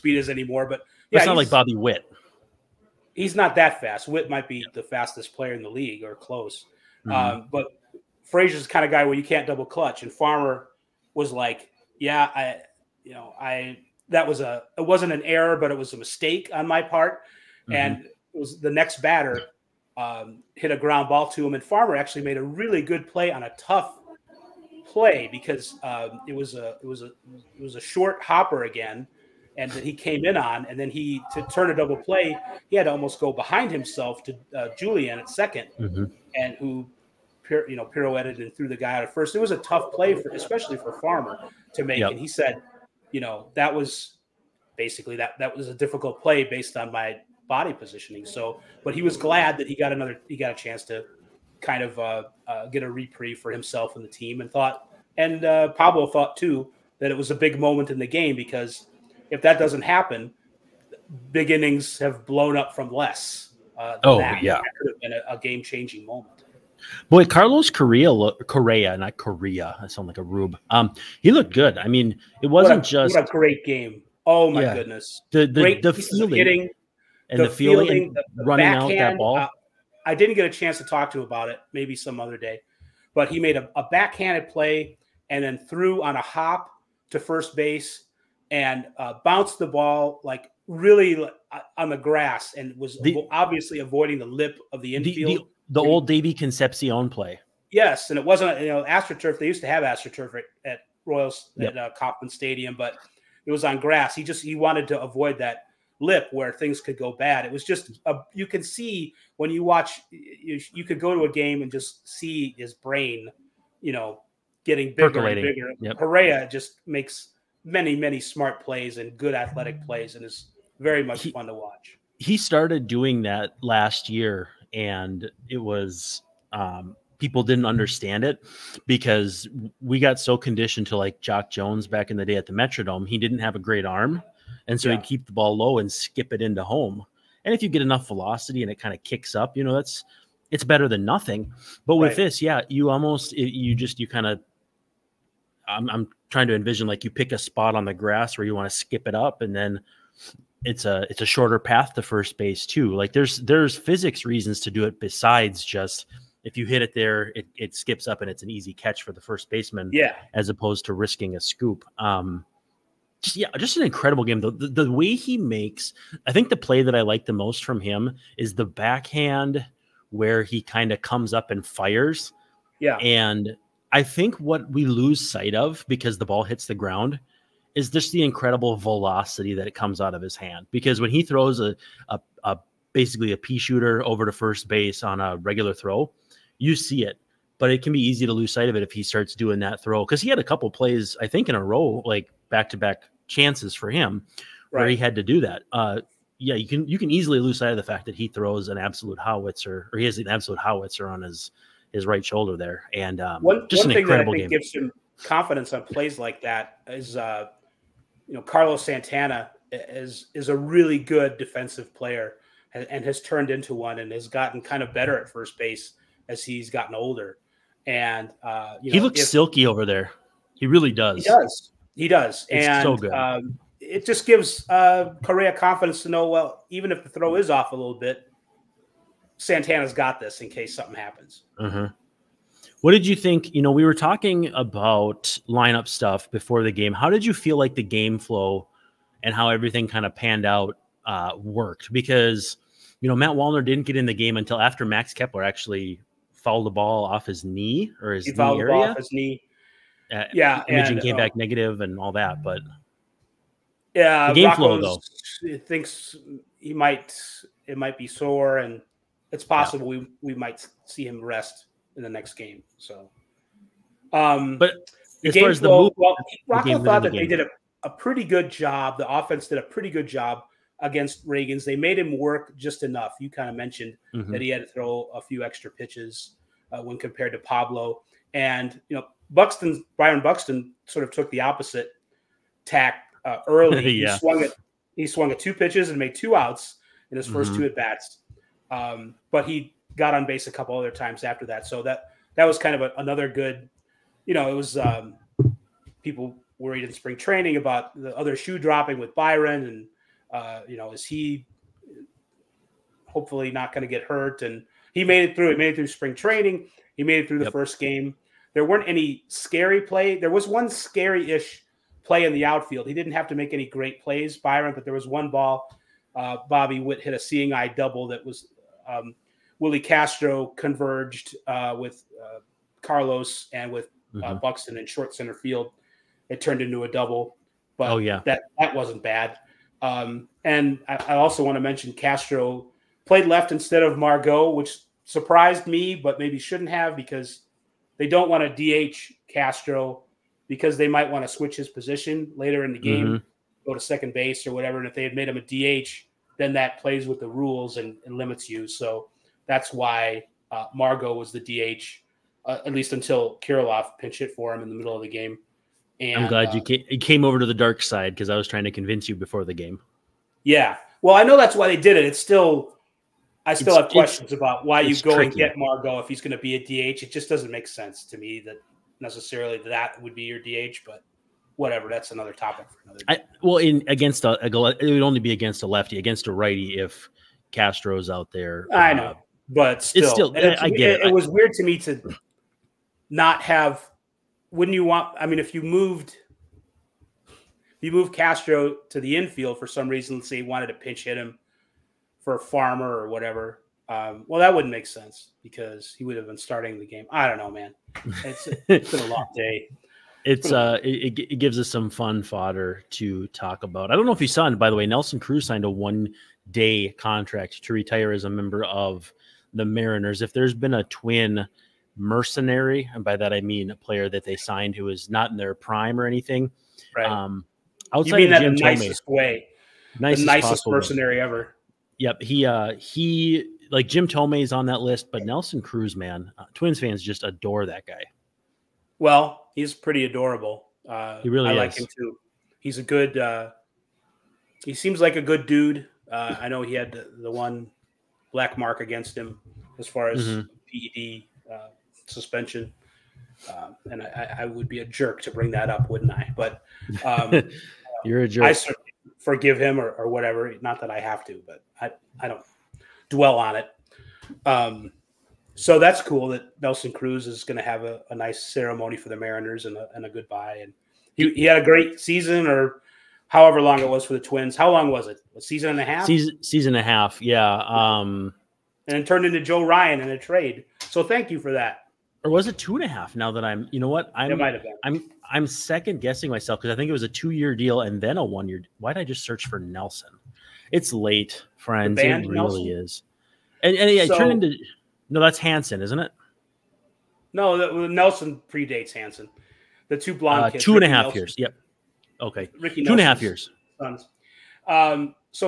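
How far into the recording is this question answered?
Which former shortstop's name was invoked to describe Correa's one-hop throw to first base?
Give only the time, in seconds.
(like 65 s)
96 s.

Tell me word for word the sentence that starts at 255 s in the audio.
Thinks he might it might be sore and it's possible yeah.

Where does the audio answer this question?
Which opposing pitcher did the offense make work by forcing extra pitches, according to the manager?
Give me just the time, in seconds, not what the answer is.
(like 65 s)
271 s.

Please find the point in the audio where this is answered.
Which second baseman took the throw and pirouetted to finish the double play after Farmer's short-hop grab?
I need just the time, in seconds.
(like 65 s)
34 s.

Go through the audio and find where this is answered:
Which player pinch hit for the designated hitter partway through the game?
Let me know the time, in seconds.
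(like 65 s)
353 s.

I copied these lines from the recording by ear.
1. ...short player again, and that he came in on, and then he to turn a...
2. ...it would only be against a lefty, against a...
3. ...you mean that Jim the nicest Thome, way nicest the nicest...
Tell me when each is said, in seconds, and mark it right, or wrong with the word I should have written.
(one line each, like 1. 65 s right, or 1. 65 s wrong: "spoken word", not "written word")
1. 27 s wrong: "hopper", not "player"
2. 374 s right
3. 418 s right.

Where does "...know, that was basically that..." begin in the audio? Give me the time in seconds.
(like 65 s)
43 s.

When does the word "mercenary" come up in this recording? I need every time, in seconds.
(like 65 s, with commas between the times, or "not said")
411 s, 420 s.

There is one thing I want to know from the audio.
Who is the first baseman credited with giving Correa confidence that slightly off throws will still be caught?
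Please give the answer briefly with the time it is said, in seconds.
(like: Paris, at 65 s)
Carlos Santana, at 208 s.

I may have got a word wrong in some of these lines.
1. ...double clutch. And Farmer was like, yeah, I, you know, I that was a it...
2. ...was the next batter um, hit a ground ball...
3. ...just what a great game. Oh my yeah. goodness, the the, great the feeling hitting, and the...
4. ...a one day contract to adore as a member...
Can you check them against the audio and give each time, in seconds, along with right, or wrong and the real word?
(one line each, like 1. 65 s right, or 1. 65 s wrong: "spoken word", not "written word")
1. 9 s right
2. 18 s right
3. 72 s right
4. 405 s wrong: "retire", not "adore".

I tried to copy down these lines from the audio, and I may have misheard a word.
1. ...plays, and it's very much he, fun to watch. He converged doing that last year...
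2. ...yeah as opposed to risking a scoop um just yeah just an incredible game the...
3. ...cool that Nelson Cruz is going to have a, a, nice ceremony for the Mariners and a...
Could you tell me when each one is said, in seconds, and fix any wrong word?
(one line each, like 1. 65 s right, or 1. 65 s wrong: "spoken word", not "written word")
1. 119 s wrong: "started", not "converged"
2. 159 s right
3. 456 s right.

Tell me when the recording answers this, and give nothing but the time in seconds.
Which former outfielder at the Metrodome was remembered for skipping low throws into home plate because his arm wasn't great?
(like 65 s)
131 s.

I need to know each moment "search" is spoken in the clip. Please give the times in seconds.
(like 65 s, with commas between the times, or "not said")
479 s.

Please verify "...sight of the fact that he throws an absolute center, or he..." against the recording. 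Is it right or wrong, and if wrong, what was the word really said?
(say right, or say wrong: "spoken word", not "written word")
wrong: "howitzer", not "center".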